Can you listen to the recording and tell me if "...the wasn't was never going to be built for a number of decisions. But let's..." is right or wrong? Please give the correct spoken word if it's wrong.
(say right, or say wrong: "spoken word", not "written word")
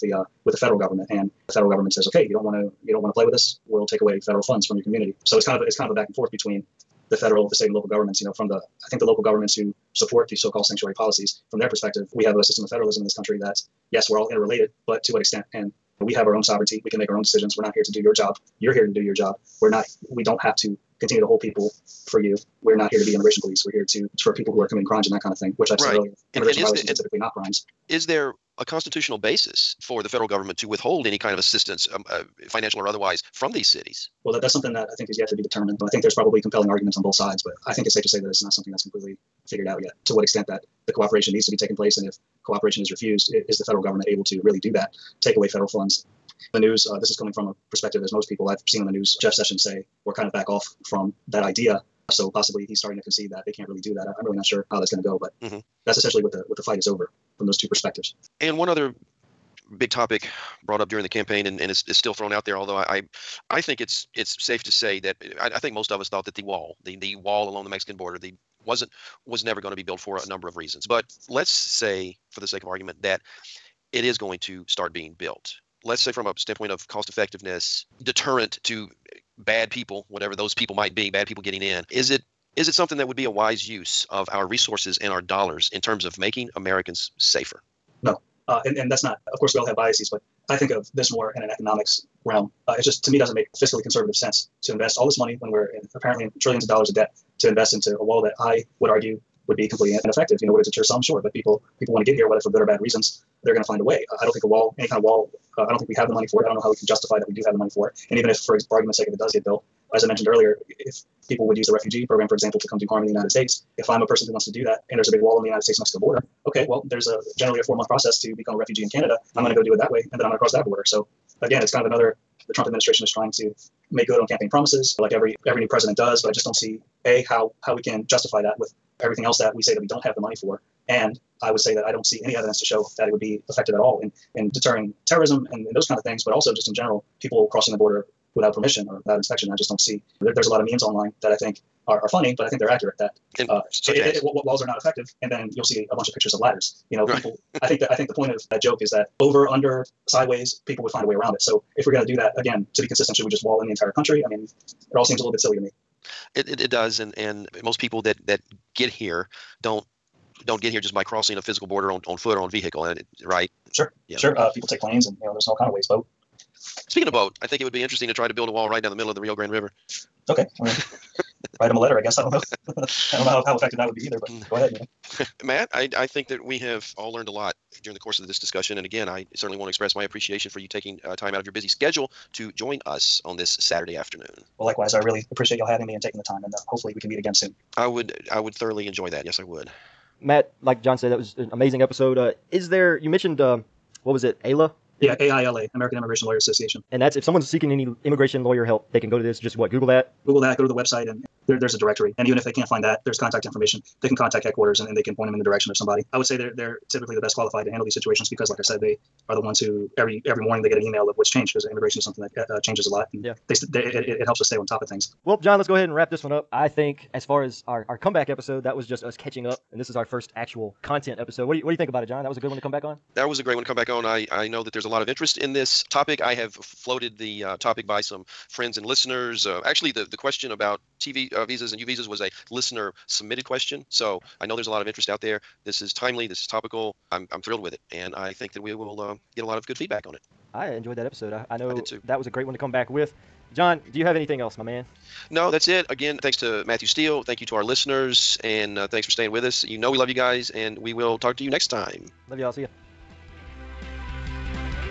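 wrong: "reasons", not "decisions".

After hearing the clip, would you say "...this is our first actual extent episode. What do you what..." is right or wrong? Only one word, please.
wrong.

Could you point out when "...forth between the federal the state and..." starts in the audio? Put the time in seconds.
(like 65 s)
6 s.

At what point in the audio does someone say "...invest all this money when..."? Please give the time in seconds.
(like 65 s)
94 s.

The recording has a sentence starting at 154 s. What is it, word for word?
I mean, it all seems a little bit silly to me.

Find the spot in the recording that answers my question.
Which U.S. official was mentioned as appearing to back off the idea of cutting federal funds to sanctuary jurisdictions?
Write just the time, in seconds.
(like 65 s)
49 s.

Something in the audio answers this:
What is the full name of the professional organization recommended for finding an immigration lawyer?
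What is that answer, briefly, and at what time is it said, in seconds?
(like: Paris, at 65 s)
American Immigration Lawyer Association, at 195 s.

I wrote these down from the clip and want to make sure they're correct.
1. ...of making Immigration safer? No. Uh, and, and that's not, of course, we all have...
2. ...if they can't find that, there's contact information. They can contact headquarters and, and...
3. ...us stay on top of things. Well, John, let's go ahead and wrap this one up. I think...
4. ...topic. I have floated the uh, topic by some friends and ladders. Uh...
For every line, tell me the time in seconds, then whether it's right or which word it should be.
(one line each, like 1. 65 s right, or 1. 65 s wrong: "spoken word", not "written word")
1. 86 s wrong: "Americans", not "Immigration"
2. 202 s right
3. 214 s right
4. 225 s wrong: "listeners", not "ladders".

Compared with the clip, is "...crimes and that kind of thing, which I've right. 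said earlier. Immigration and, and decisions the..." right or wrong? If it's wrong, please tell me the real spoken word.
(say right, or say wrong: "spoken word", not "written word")
wrong: "violations", not "decisions".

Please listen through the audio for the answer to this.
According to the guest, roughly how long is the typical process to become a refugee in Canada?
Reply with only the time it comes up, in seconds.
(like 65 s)
117 s.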